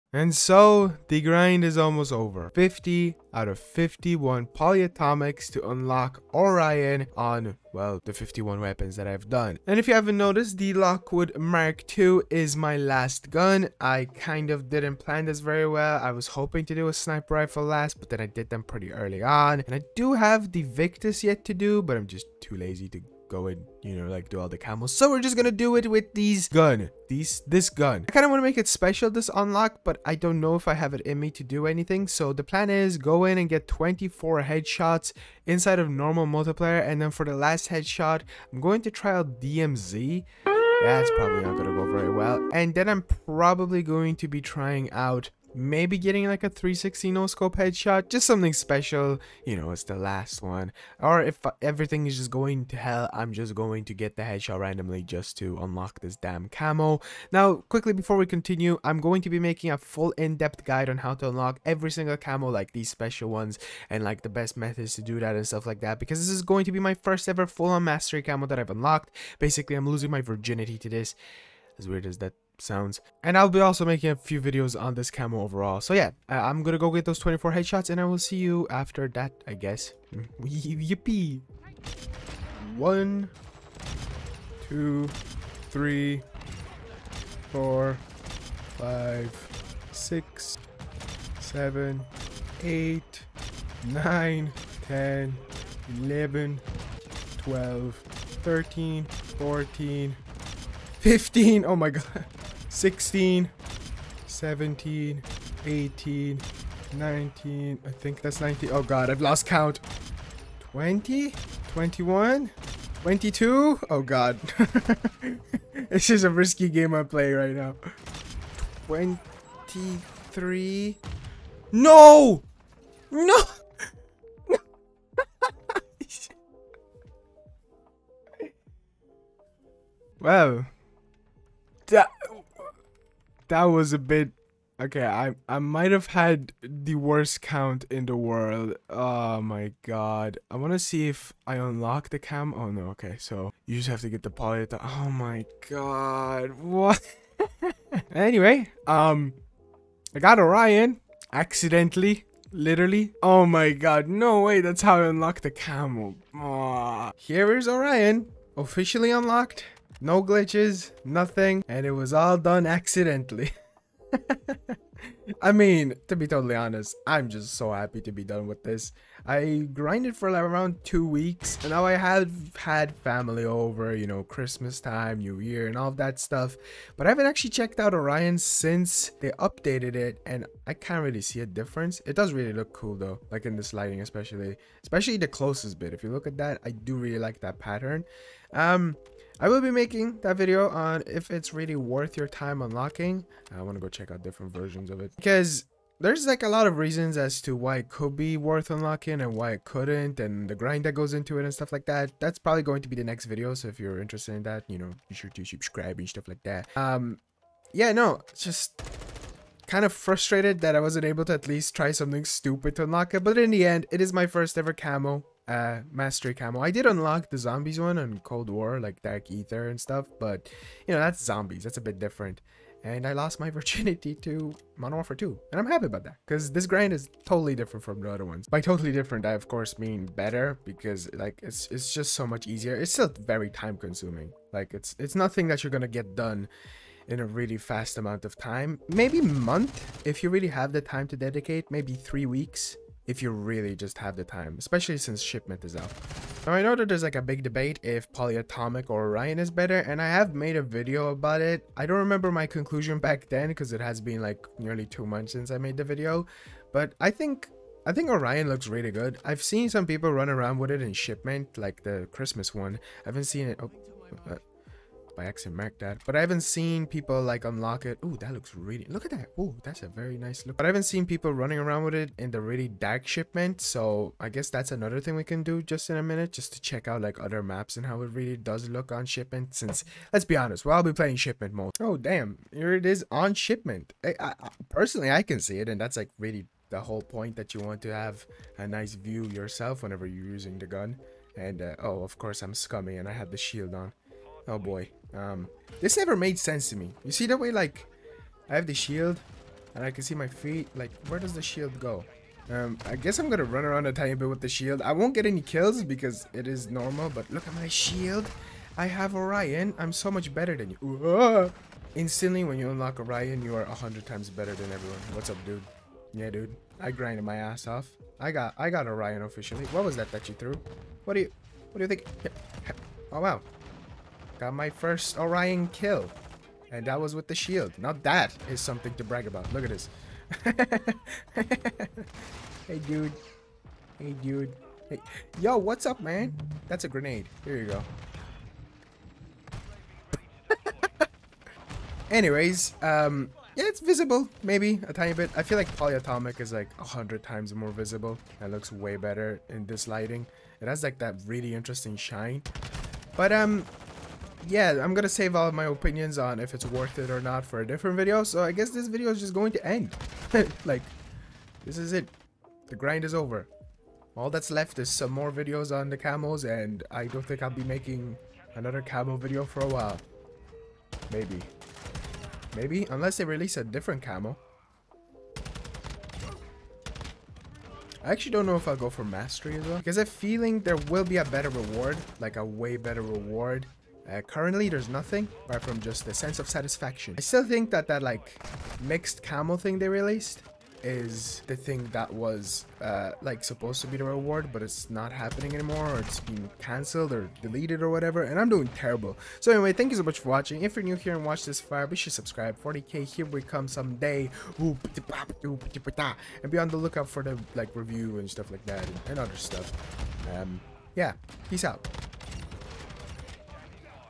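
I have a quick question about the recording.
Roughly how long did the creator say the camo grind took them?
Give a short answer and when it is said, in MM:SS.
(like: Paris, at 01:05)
two weeks, at 02:50.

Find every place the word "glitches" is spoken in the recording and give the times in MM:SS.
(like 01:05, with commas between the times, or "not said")
02:40.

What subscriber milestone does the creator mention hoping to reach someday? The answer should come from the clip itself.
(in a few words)
40k.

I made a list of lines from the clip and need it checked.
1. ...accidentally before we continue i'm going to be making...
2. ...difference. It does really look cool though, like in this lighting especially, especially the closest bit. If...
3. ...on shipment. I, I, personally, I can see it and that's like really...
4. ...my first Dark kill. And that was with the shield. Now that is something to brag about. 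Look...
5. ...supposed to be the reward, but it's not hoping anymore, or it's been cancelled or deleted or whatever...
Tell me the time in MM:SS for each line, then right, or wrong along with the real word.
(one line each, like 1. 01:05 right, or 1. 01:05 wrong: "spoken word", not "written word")
1. 00:57 wrong: "quickly", not "accidentally"
2. 03:01 right
3. 04:43 right
4. 05:24 wrong: "Orion", not "Dark"
5. 06:33 wrong: "happening", not "hoping".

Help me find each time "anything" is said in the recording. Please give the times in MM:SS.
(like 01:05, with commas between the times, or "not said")
00:31.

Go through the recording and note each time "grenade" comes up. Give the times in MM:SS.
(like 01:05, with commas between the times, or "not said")
05:36.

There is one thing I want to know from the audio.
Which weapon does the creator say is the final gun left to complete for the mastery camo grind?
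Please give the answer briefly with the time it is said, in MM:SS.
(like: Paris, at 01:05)
Lockwood Mark II, at 00:10.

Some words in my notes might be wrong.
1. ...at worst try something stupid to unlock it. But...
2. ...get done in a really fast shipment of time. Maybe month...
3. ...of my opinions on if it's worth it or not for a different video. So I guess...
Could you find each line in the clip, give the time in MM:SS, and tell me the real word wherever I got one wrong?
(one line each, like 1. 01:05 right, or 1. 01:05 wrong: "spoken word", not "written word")
1. 03:31 wrong: "least", not "worst"
2. 03:55 wrong: "amount", not "shipment"
3. 05:55 right.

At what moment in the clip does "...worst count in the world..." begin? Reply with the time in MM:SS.
02:16.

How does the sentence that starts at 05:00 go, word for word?
Like where does the shield go?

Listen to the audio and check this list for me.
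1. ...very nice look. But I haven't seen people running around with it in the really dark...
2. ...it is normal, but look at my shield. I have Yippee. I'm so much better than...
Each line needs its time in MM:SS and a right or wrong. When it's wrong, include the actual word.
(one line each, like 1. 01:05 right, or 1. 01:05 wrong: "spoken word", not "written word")
1. 04:29 right
2. 05:06 wrong: "Orion", not "Yippee".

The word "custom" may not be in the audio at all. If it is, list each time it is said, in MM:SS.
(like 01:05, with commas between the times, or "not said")
not said.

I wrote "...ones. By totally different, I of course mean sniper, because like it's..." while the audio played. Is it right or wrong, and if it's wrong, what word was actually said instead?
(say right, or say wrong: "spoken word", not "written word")
wrong: "better", not "sniper".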